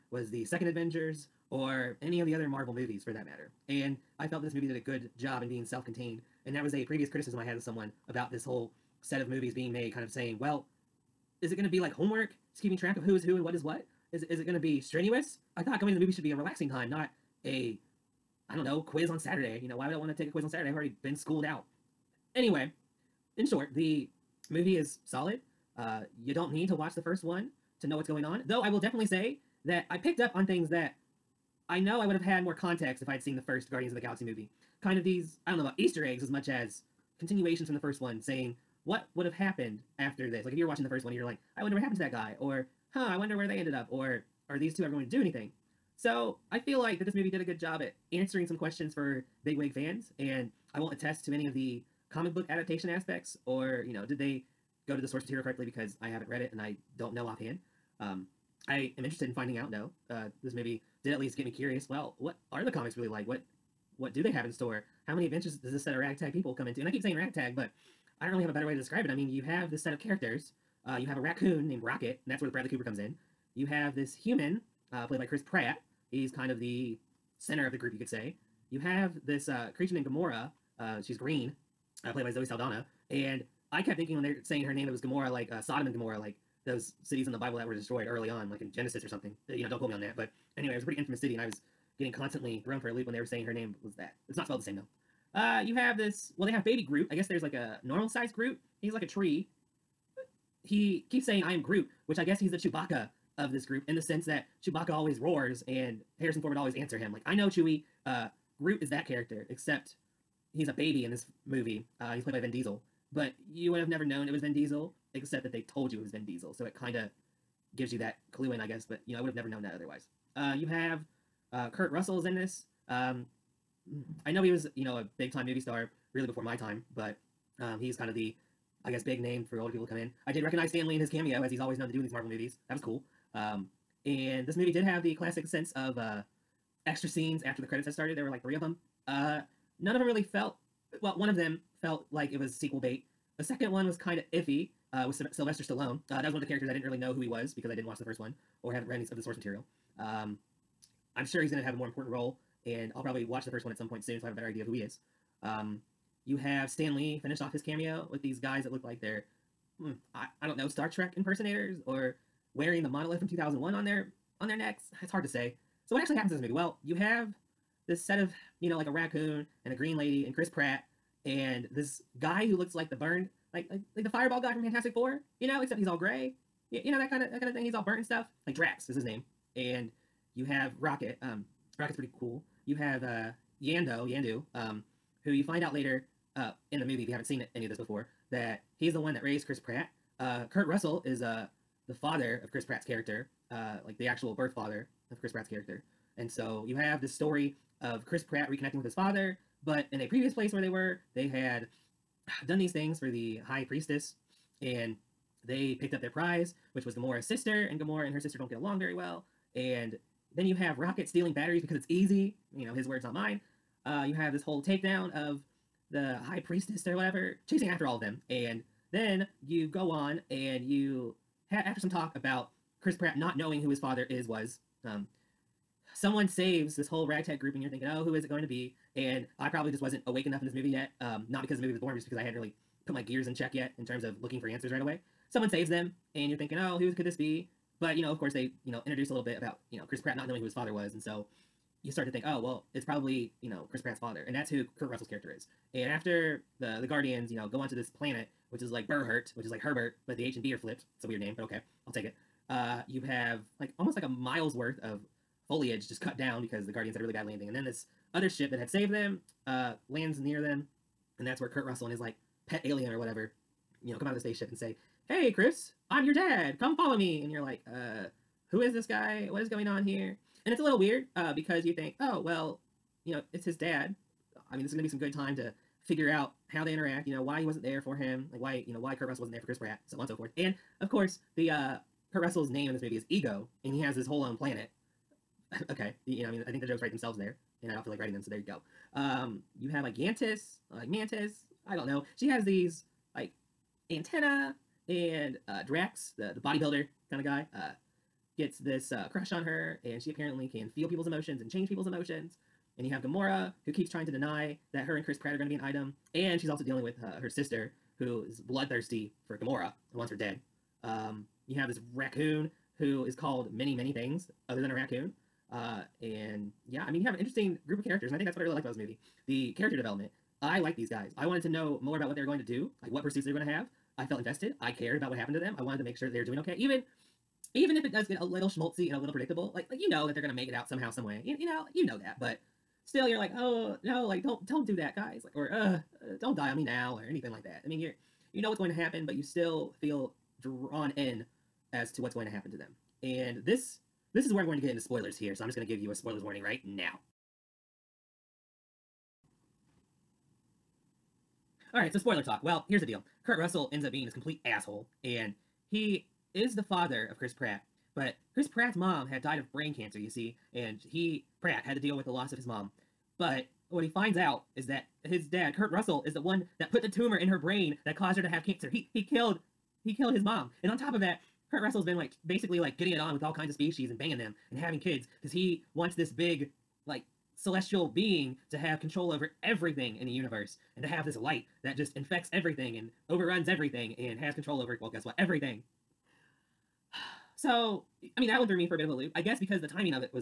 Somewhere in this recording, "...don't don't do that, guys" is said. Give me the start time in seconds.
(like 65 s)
334 s.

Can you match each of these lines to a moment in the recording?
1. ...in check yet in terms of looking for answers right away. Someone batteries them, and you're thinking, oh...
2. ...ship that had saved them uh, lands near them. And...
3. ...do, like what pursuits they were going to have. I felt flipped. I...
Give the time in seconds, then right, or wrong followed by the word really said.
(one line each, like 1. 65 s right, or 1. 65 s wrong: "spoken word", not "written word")
1. 233 s wrong: "saves", not "batteries"
2. 258 s right
3. 322 s wrong: "invested", not "flipped".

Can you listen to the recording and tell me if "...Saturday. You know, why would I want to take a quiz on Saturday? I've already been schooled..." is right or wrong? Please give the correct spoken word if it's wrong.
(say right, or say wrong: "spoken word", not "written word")
right.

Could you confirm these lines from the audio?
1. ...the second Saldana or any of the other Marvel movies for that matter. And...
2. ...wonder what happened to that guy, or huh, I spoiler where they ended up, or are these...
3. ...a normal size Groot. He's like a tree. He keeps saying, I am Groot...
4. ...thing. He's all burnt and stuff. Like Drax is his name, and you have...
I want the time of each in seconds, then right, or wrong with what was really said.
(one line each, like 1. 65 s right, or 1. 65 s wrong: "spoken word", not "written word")
1. 0 s wrong: "Avengers", not "Saldana"
2. 41 s wrong: "wonder", not "spoiler"
3. 97 s right
4. 177 s right.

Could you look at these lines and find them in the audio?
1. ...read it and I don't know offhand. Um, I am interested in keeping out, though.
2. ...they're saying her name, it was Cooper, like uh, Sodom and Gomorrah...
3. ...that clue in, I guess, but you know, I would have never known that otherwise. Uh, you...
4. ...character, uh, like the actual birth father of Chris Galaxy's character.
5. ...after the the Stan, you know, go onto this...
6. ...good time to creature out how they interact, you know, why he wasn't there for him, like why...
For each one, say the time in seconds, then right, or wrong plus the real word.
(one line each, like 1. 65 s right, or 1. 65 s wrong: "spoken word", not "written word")
1. 56 s wrong: "finding", not "keeping"
2. 84 s wrong: "Gomorrah", not "Cooper"
3. 117 s right
4. 192 s wrong: "Pratt", not "Galaxy"
5. 245 s wrong: "Guardians", not "Stan"
6. 274 s wrong: "figure", not "creature".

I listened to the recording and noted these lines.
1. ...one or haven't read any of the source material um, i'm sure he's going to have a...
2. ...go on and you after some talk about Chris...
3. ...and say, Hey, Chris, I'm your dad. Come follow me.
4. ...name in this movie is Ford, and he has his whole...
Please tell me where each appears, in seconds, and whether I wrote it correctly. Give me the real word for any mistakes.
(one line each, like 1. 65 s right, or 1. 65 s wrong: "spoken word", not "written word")
1. 148 s right
2. 219 s right
3. 264 s right
4. 282 s wrong: "Ego", not "Ford".